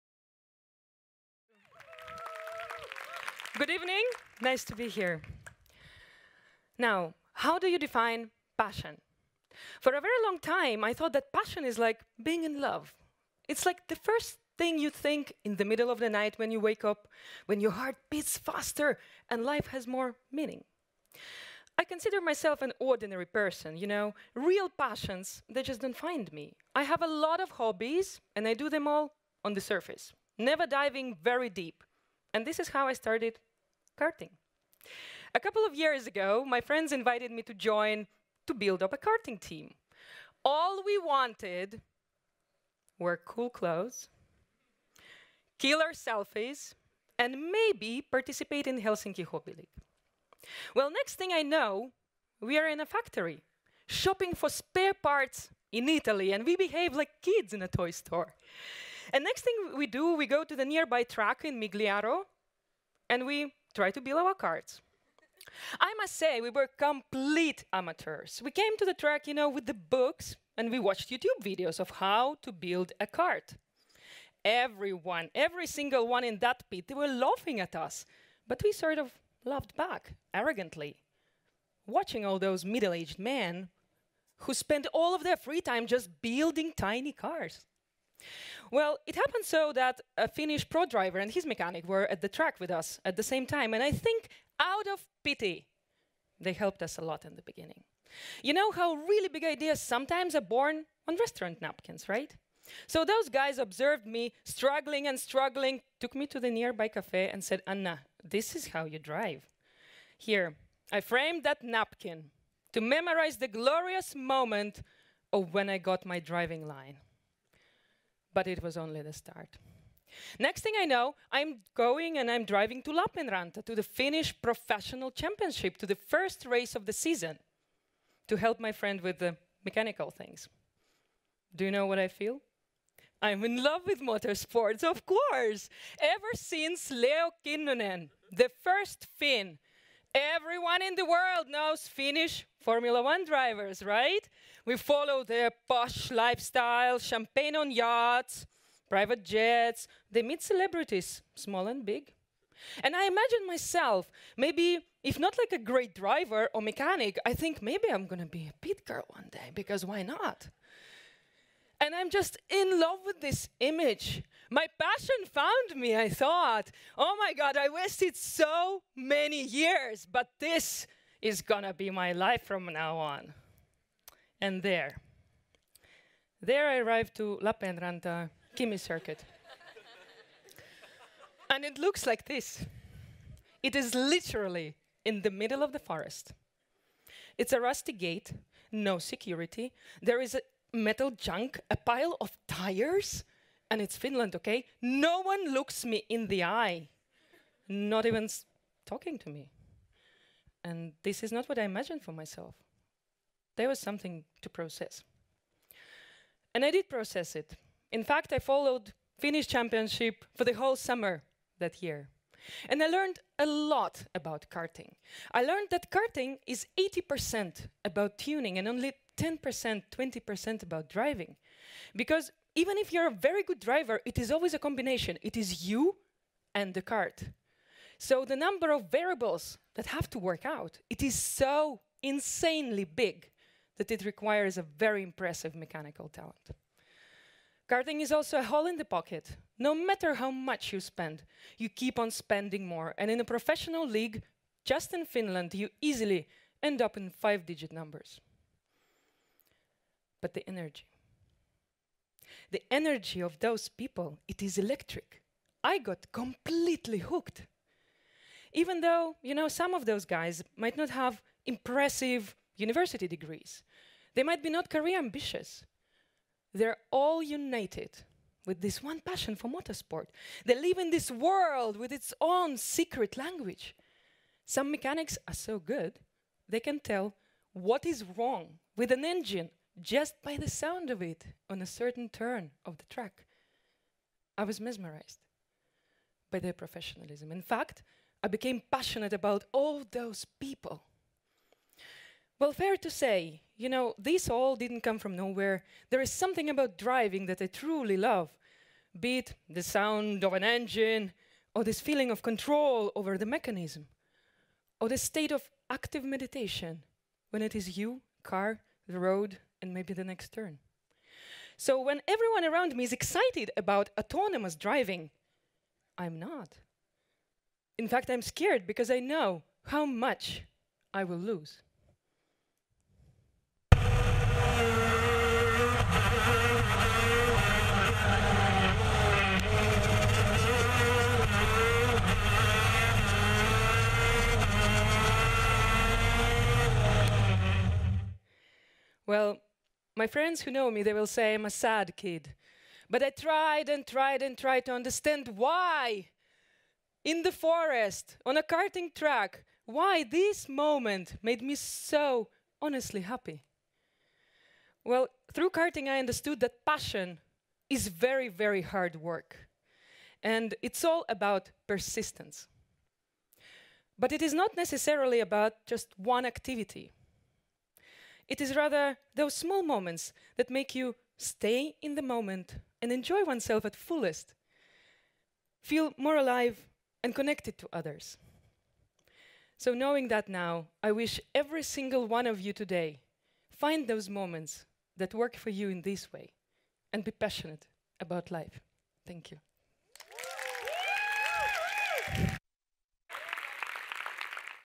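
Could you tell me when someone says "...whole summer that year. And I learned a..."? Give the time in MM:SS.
03:30.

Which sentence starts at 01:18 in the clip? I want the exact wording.
But we sort of laughed back, arrogantly.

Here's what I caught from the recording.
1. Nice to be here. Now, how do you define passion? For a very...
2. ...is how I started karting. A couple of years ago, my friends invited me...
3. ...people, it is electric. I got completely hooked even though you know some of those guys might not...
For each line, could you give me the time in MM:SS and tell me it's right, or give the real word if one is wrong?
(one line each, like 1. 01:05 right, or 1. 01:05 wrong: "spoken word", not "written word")
1. 00:04 right
2. 00:32 right
3. 04:13 right.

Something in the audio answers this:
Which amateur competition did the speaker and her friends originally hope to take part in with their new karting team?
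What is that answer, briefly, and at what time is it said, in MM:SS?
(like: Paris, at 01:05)
Helsinki Hobby League, at 00:48.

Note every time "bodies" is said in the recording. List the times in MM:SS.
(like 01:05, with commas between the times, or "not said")
not said.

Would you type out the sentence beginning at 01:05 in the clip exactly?
I must say, we were complete amateurs.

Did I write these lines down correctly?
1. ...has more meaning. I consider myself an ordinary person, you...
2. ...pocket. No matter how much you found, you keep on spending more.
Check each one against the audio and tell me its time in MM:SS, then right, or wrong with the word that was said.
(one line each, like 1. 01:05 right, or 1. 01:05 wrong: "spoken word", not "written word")
1. 00:19 right
2. 03:58 wrong: "spend", not "found".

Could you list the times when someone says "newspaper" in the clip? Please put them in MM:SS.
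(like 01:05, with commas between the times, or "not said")
not said.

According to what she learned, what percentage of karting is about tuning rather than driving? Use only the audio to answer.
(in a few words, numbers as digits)
80%.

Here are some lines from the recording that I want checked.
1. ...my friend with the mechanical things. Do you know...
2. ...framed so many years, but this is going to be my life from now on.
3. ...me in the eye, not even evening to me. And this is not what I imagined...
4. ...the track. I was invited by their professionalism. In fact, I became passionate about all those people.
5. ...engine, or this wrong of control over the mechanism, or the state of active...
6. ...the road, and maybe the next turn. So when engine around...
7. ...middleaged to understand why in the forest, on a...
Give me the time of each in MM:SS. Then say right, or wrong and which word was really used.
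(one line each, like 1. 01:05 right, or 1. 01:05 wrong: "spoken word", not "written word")
1. 02:08 right
2. 02:47 wrong: "wasted", not "framed"
3. 03:15 wrong: "talking", not "evening"
4. 04:42 wrong: "mesmerized", not "invited"
5. 05:00 wrong: "feeling", not "wrong"
6. 05:08 wrong: "everyone", not "engine"
7. 05:44 wrong: "tried", not "middleaged".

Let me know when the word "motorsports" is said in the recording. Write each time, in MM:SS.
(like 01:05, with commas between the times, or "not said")
02:14, 04:29.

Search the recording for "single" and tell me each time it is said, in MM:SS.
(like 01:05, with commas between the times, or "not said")
01:15, 06:21.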